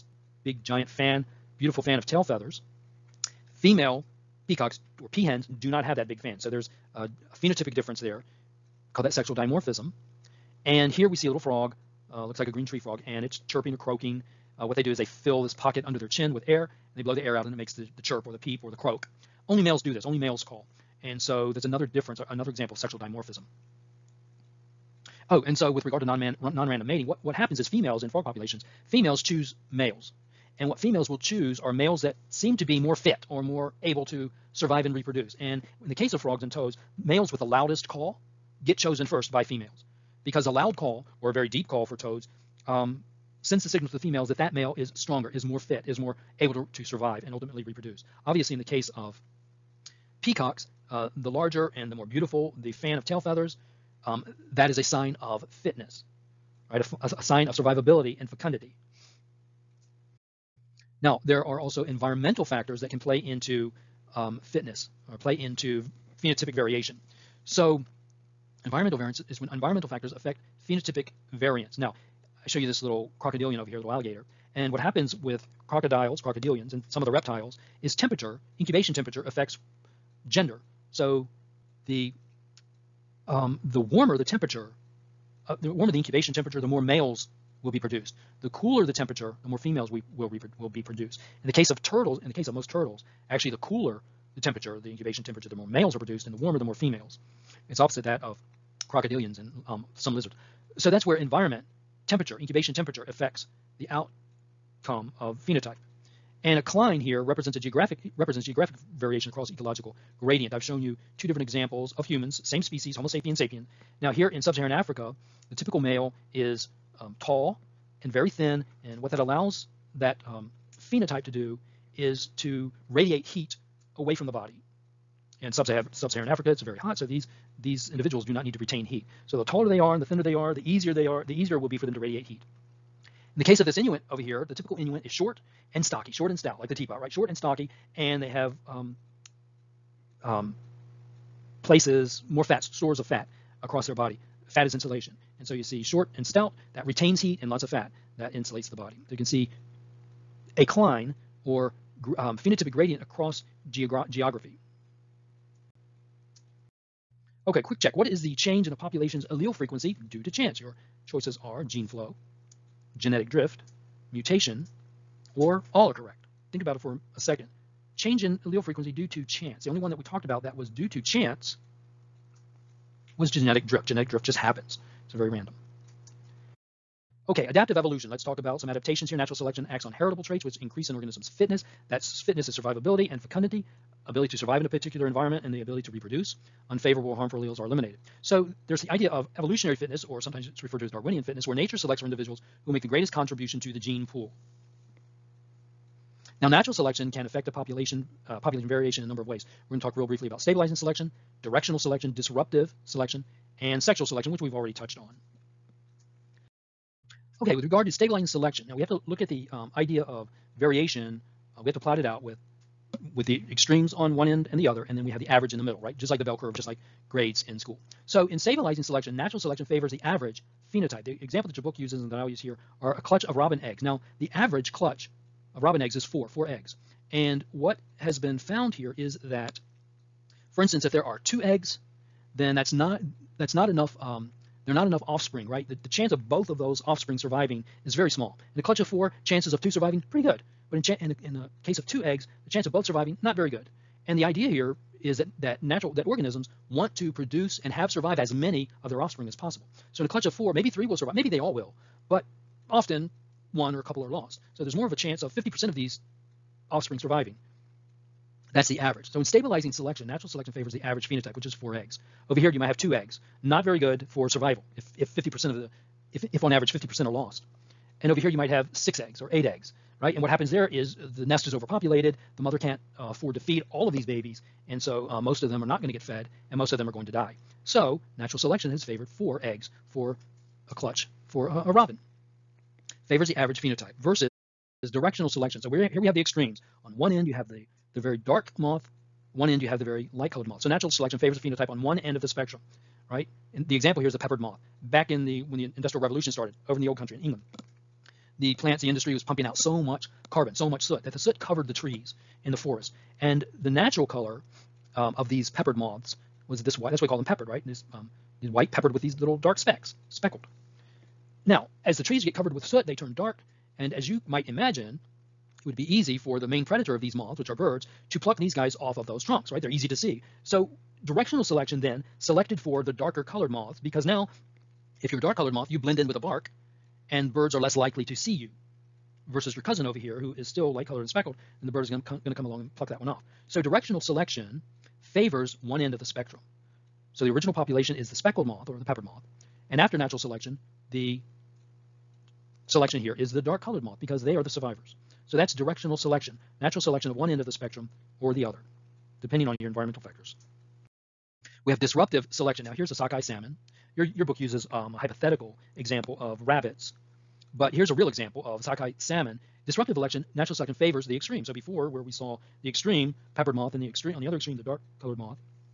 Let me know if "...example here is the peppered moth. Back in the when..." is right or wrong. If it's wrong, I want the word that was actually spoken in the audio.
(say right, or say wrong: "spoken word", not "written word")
right.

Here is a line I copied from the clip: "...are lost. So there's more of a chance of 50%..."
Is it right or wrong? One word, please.
right.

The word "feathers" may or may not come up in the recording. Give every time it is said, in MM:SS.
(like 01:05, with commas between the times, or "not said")
00:02, 00:53.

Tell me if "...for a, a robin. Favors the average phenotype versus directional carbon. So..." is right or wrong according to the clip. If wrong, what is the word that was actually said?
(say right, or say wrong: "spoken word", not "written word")
wrong: "selection", not "carbon".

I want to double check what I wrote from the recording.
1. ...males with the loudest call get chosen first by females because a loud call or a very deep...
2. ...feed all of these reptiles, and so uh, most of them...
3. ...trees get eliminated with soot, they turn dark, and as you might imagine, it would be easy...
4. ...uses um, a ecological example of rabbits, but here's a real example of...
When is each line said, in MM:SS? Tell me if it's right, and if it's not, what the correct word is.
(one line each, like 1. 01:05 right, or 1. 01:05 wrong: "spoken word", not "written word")
1. 00:36 right
2. 04:33 wrong: "babies", not "reptiles"
3. 05:12 wrong: "covered", not "eliminated"
4. 05:54 wrong: "hypothetical", not "ecological".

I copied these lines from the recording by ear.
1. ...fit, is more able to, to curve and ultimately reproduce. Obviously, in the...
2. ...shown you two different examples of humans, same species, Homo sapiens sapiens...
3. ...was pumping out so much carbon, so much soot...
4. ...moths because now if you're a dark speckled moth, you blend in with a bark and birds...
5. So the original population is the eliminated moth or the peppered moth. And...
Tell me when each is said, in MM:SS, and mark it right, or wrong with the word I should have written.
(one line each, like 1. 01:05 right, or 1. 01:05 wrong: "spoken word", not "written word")
1. 00:45 wrong: "survive", not "curve"
2. 01:50 right
3. 04:59 right
4. 05:23 wrong: "colored", not "speckled"
5. 05:37 wrong: "speckled", not "eliminated".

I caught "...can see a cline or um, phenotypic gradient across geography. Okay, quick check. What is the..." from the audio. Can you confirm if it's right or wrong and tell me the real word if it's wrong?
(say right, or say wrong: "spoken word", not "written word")
right.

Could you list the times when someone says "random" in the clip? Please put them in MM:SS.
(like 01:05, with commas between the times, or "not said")
00:26, 02:55.